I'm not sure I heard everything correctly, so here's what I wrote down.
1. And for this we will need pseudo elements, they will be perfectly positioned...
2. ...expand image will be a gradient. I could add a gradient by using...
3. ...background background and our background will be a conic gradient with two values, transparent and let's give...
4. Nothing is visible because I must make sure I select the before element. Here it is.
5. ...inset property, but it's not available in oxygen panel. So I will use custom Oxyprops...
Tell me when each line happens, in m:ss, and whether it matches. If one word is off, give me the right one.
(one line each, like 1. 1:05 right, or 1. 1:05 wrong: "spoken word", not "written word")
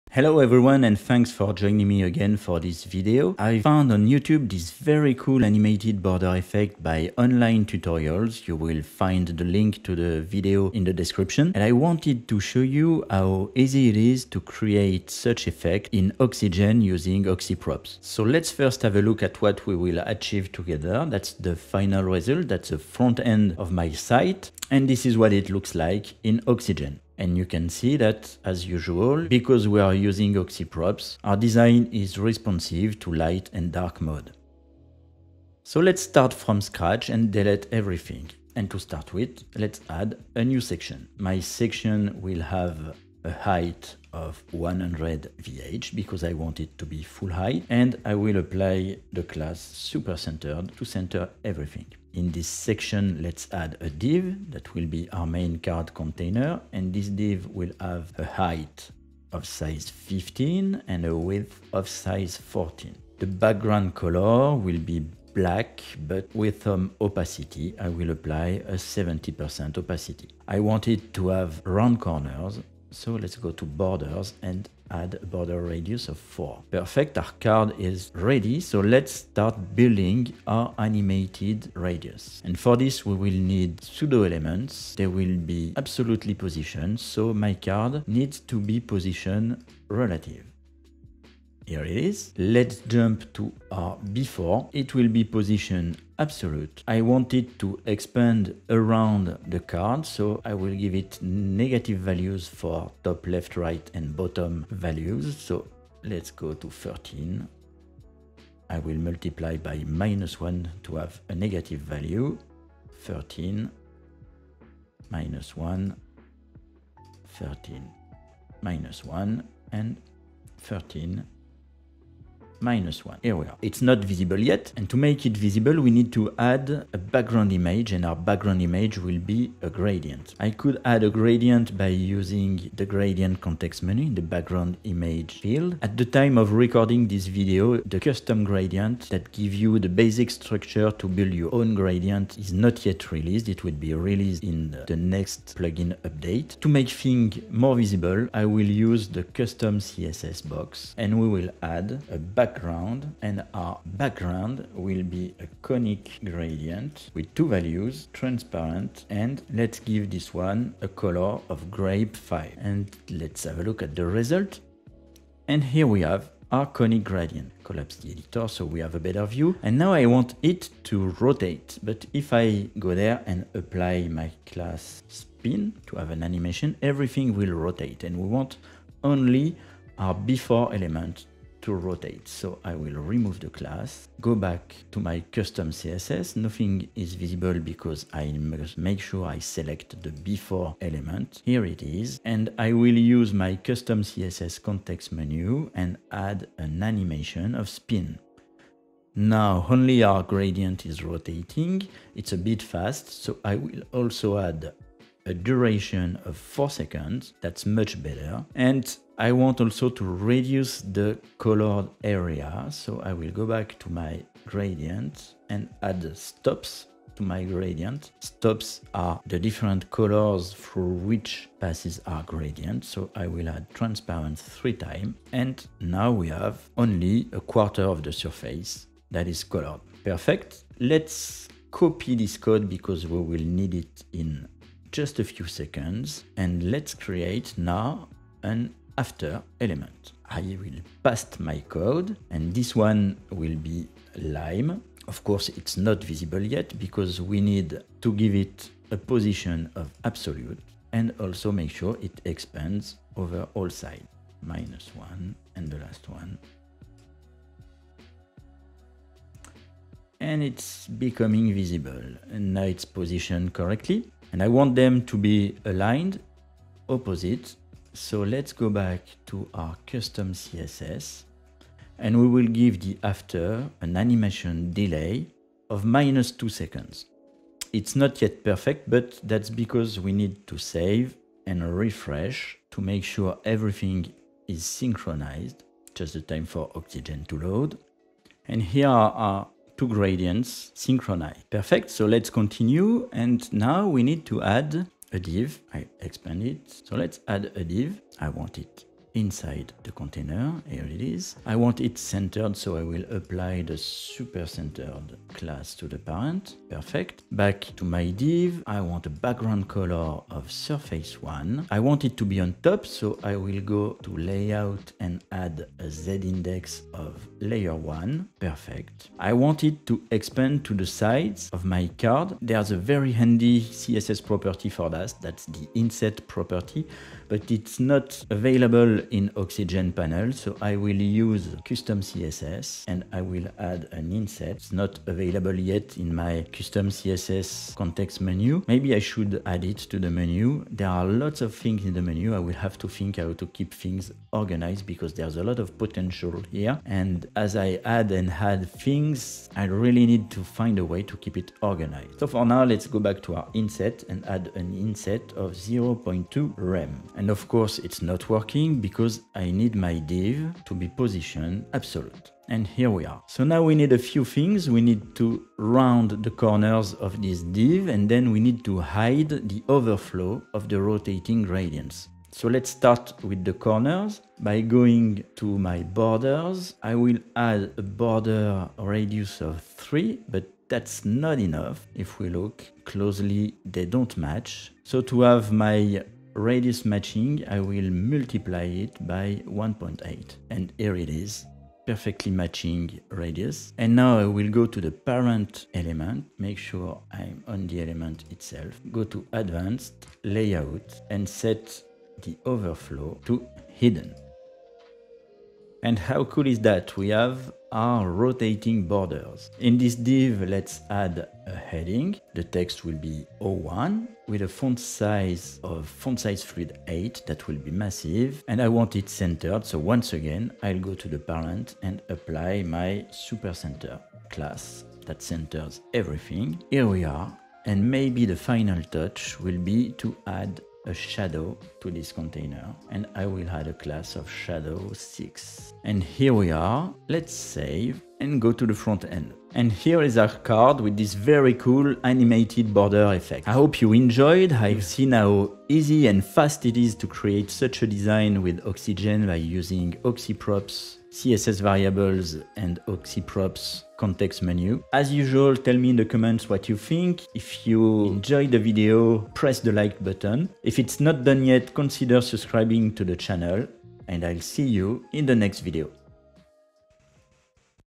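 1. 1:22 wrong: "absolutely", not "perfectly"
2. 2:08 wrong: "background", not "expand"
3. 2:32 right
4. 3:06 right
5. 5:25 wrong: "CSS", not "Oxyprops".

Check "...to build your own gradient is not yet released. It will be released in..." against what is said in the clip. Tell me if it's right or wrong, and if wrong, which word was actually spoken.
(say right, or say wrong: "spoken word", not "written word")
right.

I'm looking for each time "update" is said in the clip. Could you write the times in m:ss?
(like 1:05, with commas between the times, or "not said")
2:26.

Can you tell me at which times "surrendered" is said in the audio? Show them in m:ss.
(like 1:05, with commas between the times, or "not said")
not said.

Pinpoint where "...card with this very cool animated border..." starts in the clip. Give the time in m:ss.
7:20.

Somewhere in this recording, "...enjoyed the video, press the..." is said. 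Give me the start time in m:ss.
7:38.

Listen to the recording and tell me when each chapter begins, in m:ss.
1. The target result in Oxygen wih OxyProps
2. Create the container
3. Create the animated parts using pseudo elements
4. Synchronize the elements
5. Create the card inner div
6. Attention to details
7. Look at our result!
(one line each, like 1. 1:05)
1. 0:19
2. 0:40
3. 1:21
4. 4:23
5. 4:50
6. 6:03
7. 7:20.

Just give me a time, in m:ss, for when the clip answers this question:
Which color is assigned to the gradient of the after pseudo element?
4:04.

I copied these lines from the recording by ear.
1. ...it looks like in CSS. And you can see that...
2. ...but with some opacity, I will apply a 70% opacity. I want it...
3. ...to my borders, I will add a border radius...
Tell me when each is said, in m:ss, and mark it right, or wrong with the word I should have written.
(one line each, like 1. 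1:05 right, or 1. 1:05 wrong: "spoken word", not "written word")
1. 0:25 wrong: "Oxygen", not "CSS"
2. 1:06 right
3. 6:15 right.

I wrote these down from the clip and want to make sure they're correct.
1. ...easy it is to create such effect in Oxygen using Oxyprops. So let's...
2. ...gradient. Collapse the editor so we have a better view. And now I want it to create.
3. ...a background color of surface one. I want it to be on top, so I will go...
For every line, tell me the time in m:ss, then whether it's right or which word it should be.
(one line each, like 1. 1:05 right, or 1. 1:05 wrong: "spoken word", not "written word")
1. 0:13 right
2. 2:47 wrong: "rotate", not "create"
3. 5:09 right.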